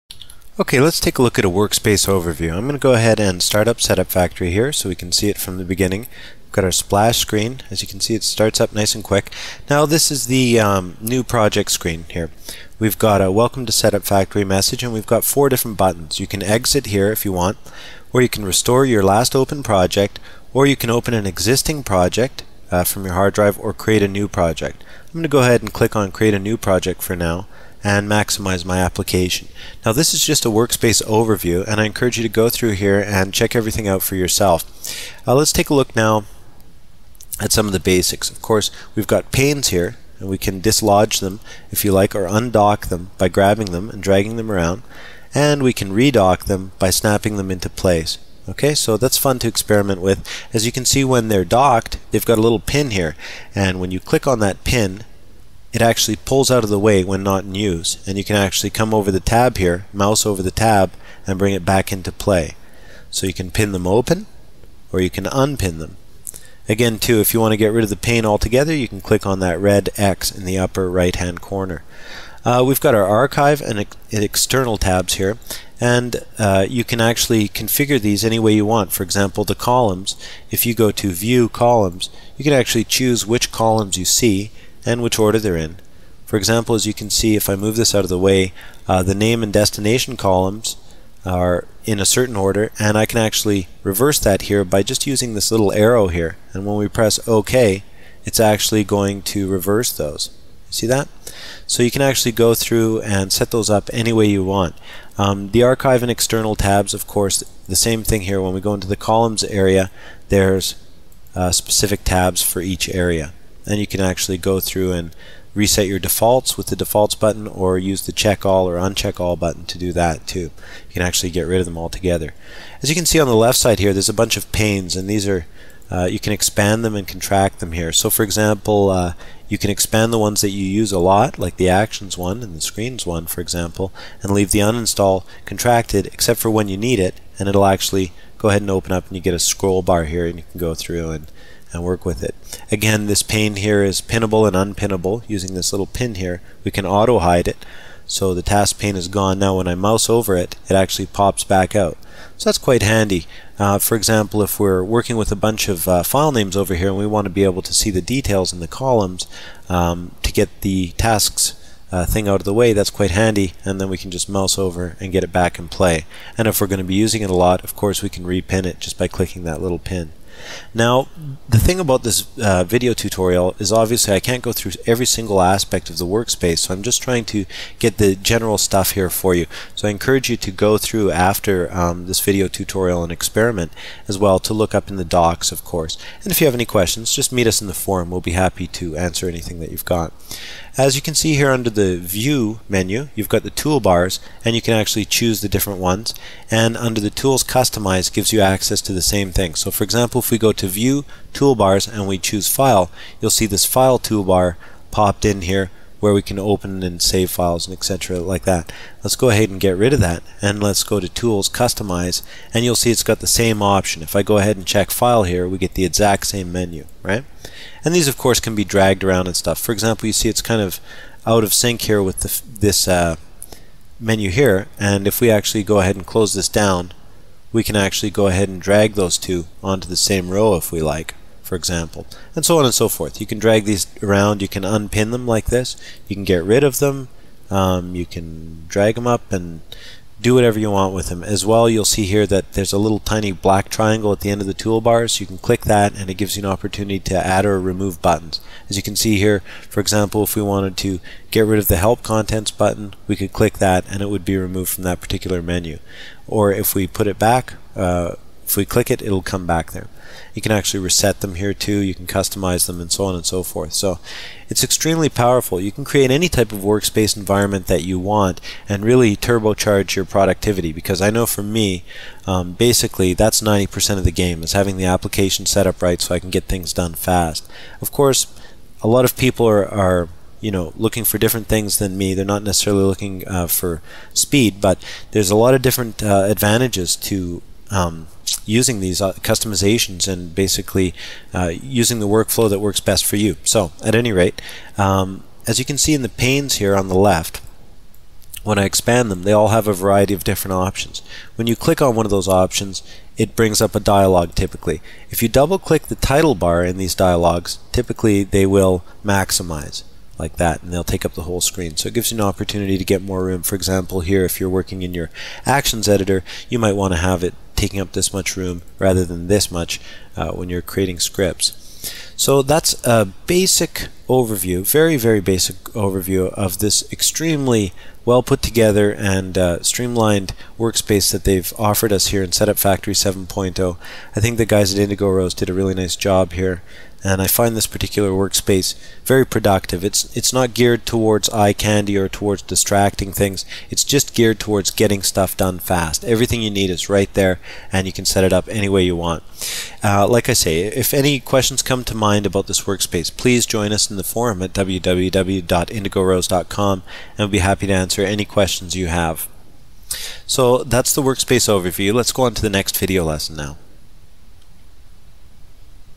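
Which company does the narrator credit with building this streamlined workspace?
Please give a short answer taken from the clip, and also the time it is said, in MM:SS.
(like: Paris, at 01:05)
Indigo Rose, at 05:34.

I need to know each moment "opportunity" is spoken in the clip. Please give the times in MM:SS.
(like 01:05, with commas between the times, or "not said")
04:06, 05:12.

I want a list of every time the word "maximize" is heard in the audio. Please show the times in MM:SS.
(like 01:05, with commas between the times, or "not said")
00:28, 05:09.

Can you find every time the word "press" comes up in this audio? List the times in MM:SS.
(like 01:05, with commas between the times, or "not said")
01:36.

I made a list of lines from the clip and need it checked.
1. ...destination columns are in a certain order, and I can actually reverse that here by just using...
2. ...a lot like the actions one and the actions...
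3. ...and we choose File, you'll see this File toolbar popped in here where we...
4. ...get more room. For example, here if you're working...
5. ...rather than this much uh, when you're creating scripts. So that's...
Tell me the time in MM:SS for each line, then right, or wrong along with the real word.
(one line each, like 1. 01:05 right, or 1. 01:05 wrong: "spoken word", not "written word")
1. 01:29 right
2. 02:10 wrong: "screens", not "actions"
3. 03:21 right
4. 05:12 right
5. 05:18 right.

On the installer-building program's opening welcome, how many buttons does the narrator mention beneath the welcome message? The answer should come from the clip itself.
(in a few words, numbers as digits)
4.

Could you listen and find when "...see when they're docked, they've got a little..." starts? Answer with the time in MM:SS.
00:50.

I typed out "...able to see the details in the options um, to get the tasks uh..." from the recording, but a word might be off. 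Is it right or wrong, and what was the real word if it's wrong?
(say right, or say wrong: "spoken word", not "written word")
wrong: "columns", not "options".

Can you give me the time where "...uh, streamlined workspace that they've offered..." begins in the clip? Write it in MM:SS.
05:29.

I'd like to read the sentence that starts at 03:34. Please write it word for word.
If I go ahead and check File here, we get the exact same menu, right?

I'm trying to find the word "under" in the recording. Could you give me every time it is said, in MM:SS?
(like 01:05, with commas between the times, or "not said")
03:11, 03:16.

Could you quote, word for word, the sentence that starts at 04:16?
Or if we put it back, uh, if we click it, it'll come back there.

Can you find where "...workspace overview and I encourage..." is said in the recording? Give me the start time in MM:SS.
00:30.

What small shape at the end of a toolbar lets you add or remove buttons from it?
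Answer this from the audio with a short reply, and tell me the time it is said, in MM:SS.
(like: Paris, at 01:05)
black triangle, at 04:03.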